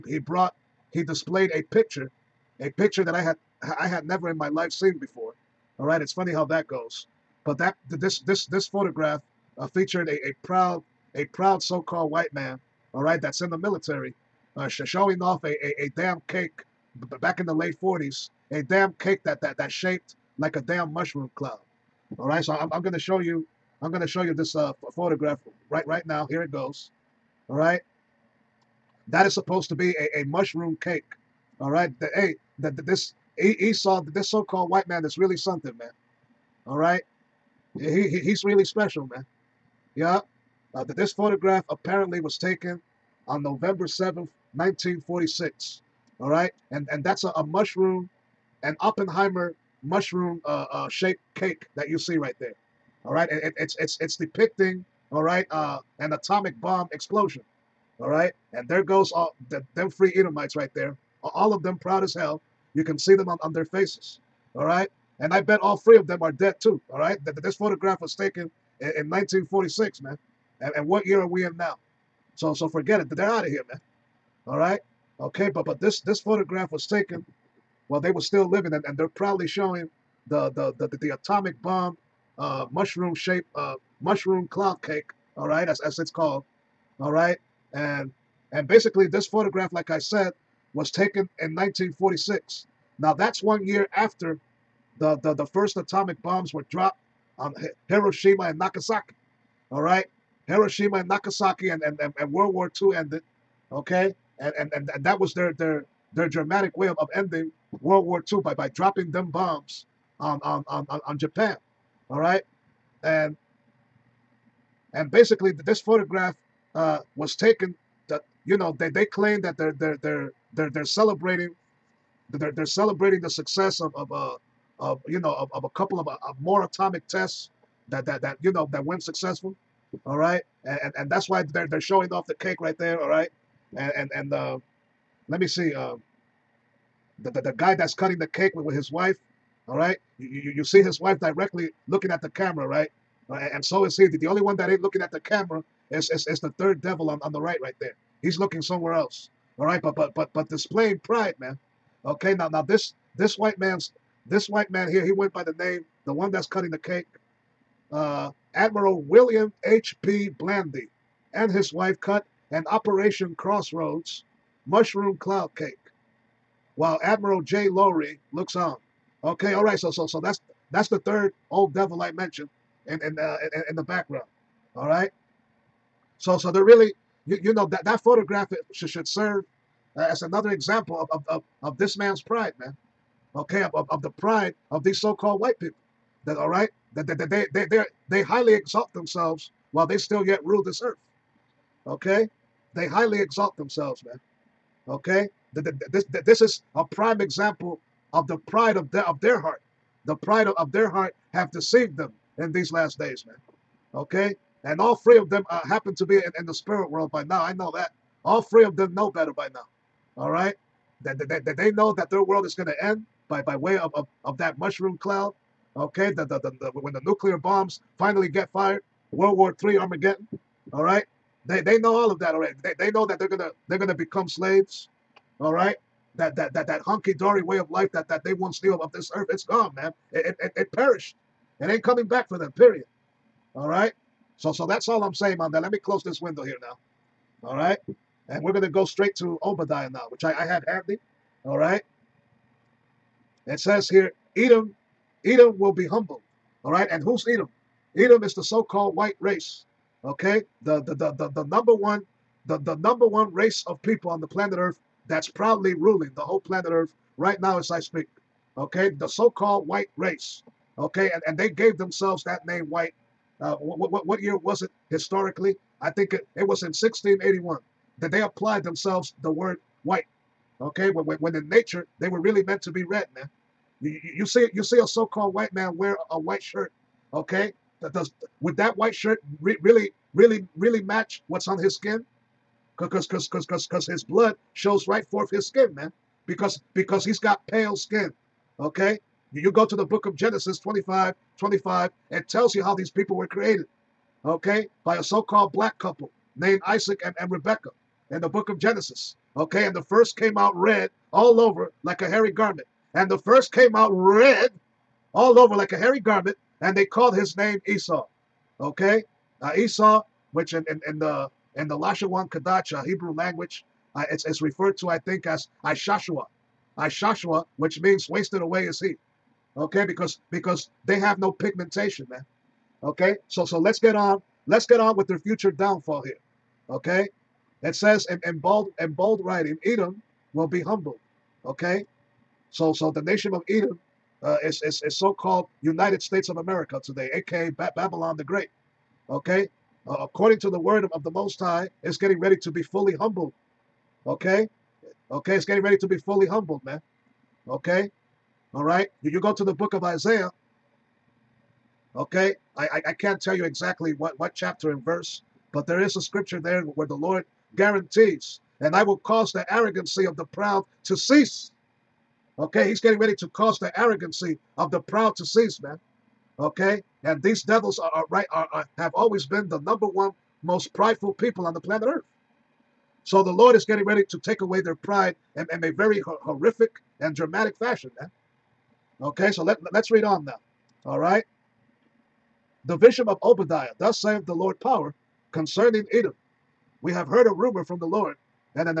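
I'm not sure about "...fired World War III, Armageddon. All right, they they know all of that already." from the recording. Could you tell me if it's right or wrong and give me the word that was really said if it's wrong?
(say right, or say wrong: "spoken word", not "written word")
right.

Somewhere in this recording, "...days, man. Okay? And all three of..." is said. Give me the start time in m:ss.
3:22.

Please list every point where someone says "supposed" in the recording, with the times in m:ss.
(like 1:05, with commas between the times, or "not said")
0:29.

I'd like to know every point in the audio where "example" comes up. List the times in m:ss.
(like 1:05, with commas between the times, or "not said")
3:00, 3:17.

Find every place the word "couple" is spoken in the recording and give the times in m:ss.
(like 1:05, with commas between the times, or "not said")
2:05, 4:55.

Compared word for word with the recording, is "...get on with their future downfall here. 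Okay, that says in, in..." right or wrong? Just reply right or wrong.
right.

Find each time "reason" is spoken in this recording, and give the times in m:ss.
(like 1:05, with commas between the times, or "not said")
not said.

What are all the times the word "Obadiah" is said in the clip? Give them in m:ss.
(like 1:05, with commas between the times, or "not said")
3:59, 6:23.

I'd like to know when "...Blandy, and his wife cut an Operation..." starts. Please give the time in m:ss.
2:40.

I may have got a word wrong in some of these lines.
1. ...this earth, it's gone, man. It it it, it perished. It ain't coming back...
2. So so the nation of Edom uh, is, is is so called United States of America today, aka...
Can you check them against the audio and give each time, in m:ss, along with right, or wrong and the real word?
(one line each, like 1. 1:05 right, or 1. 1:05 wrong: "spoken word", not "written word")
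1. 3:48 right
2. 5:32 right.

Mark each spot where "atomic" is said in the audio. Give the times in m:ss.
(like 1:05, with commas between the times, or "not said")
0:56, 1:21, 1:35, 2:06.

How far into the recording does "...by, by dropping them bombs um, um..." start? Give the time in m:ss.
1:48.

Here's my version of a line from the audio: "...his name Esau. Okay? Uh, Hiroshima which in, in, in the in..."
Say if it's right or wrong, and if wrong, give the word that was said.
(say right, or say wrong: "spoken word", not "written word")
wrong: "Esau", not "Hiroshima".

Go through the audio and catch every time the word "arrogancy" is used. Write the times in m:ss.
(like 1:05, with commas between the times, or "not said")
5:59, 6:03.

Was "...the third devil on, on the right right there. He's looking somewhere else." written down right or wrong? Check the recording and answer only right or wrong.
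right.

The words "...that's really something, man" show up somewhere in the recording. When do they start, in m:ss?
0:35.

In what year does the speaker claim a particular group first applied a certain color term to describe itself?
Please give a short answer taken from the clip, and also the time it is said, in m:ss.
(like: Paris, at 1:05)
1681, at 4:26.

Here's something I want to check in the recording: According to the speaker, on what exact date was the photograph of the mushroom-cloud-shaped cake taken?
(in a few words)
November 7, 1946.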